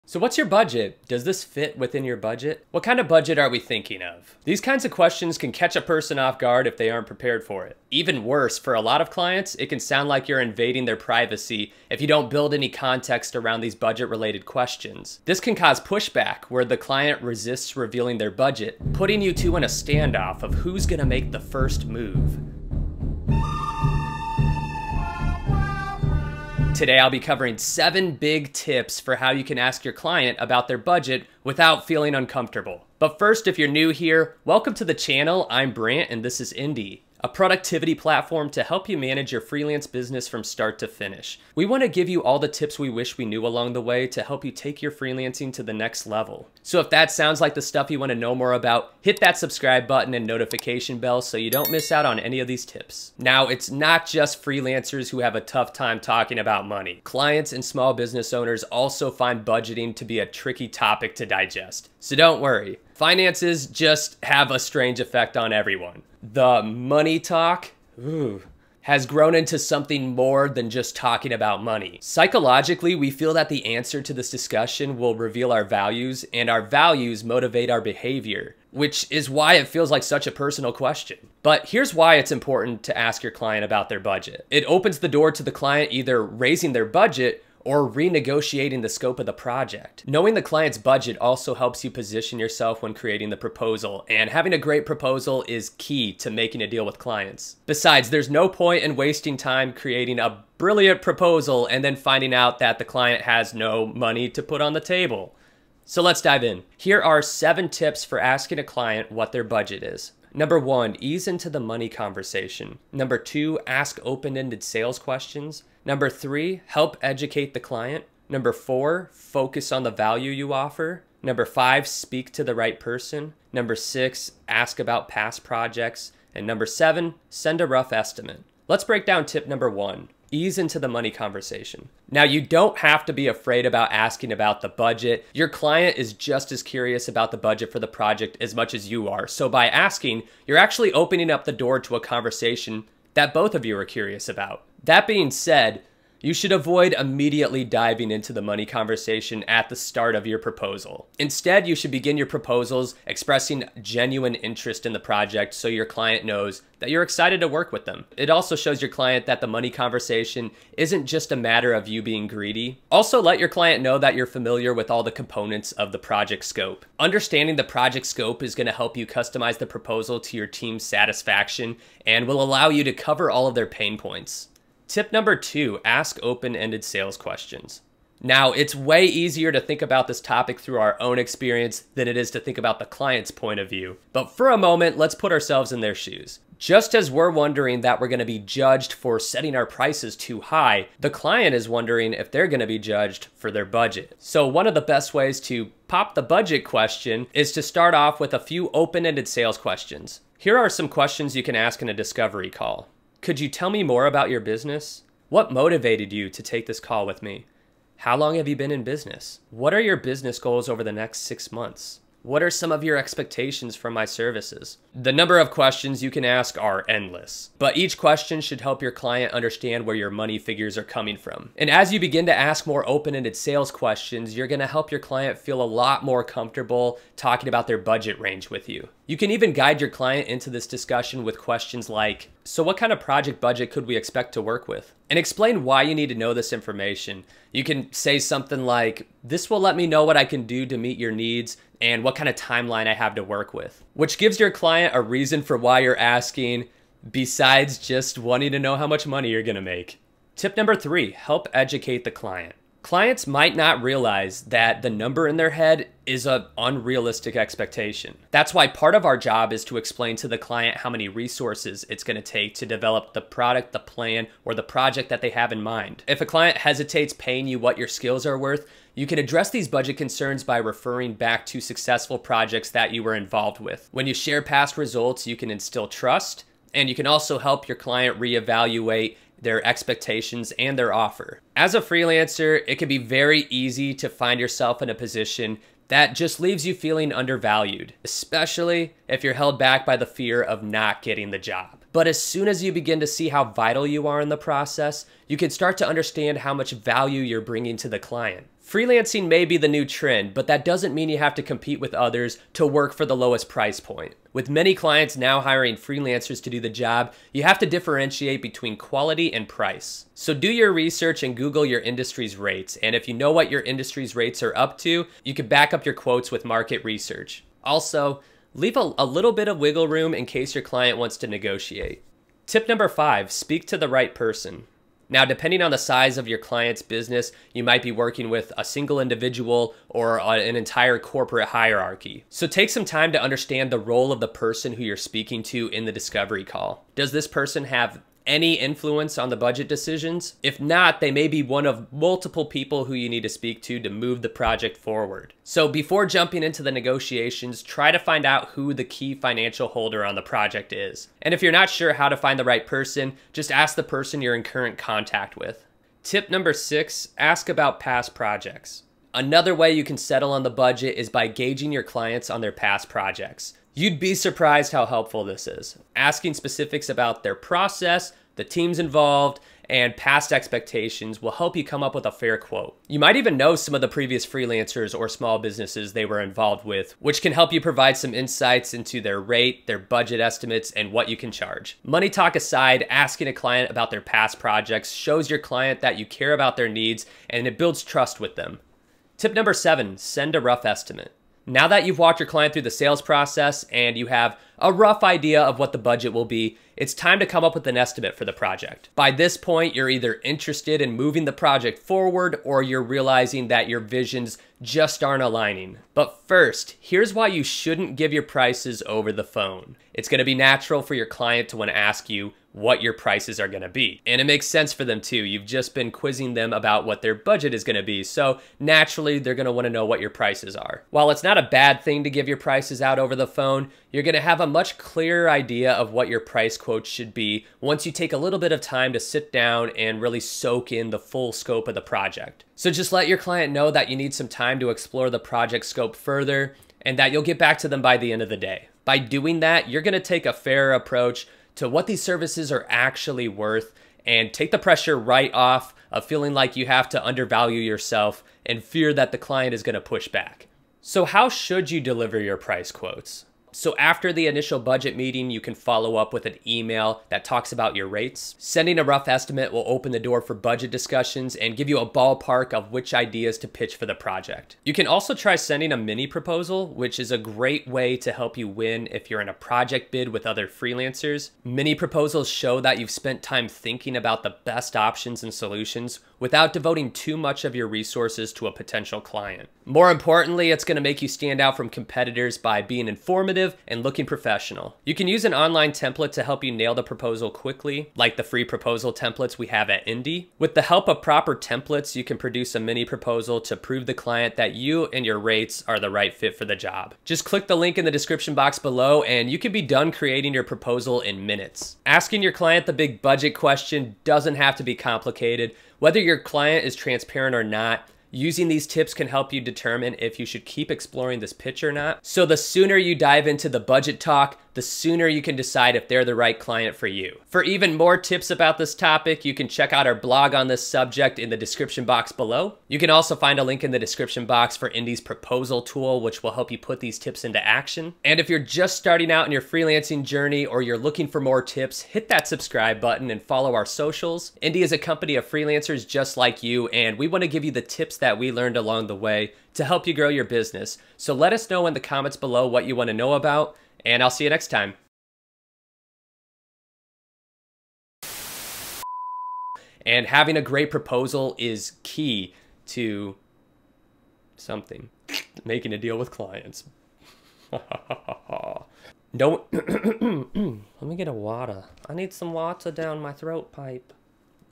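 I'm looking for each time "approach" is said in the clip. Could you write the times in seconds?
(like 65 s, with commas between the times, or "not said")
440 s.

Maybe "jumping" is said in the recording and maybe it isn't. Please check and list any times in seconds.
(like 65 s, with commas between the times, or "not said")
346 s.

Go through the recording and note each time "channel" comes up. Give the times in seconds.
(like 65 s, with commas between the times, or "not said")
34 s.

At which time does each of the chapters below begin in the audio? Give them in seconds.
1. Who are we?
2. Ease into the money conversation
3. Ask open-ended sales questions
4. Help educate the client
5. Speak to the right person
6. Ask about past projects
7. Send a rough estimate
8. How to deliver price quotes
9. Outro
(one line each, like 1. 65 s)
1. 31 s
2. 128 s
3. 174 s
4. 250 s
5. 322 s
6. 354 s
7. 388 s
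8. 450 s
9. 516 s.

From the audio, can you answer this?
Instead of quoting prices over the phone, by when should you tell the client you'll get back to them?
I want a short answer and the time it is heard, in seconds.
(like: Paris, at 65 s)
End of the day, at 438 s.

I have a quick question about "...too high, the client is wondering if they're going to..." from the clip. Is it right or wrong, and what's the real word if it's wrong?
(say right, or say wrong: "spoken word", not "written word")
right.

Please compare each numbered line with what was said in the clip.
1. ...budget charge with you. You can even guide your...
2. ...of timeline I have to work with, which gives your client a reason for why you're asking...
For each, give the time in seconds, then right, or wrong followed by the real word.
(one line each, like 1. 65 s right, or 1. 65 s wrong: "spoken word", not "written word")
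1. 227 s wrong: "range", not "charge"
2. 242 s right.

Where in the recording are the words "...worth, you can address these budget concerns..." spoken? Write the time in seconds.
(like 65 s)
268 s.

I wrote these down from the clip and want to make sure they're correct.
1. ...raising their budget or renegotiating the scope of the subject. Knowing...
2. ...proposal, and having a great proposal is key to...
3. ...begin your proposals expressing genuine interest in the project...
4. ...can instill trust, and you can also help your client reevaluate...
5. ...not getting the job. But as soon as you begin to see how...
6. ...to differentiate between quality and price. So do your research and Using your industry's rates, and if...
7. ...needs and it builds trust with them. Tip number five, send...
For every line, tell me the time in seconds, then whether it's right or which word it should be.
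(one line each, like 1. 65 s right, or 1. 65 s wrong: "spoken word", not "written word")
1. 86 s wrong: "project", not "subject"
2. 93 s right
3. 151 s right
4. 275 s right
5. 290 s right
6. 307 s wrong: "Google", not "Using"
7. 386 s wrong: "seven", not "five".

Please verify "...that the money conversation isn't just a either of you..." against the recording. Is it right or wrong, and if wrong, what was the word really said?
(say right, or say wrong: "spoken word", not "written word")
wrong: "matter", not "either".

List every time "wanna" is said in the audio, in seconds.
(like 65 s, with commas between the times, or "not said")
411 s, 419 s.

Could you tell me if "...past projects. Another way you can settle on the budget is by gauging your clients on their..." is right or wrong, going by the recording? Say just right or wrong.
right.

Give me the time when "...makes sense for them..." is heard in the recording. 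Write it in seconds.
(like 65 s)
414 s.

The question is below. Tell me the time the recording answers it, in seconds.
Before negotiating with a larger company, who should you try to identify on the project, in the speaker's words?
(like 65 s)
348 s.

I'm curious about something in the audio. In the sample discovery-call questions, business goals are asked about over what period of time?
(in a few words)
Six months.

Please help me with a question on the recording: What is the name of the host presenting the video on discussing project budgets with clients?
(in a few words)
Brant.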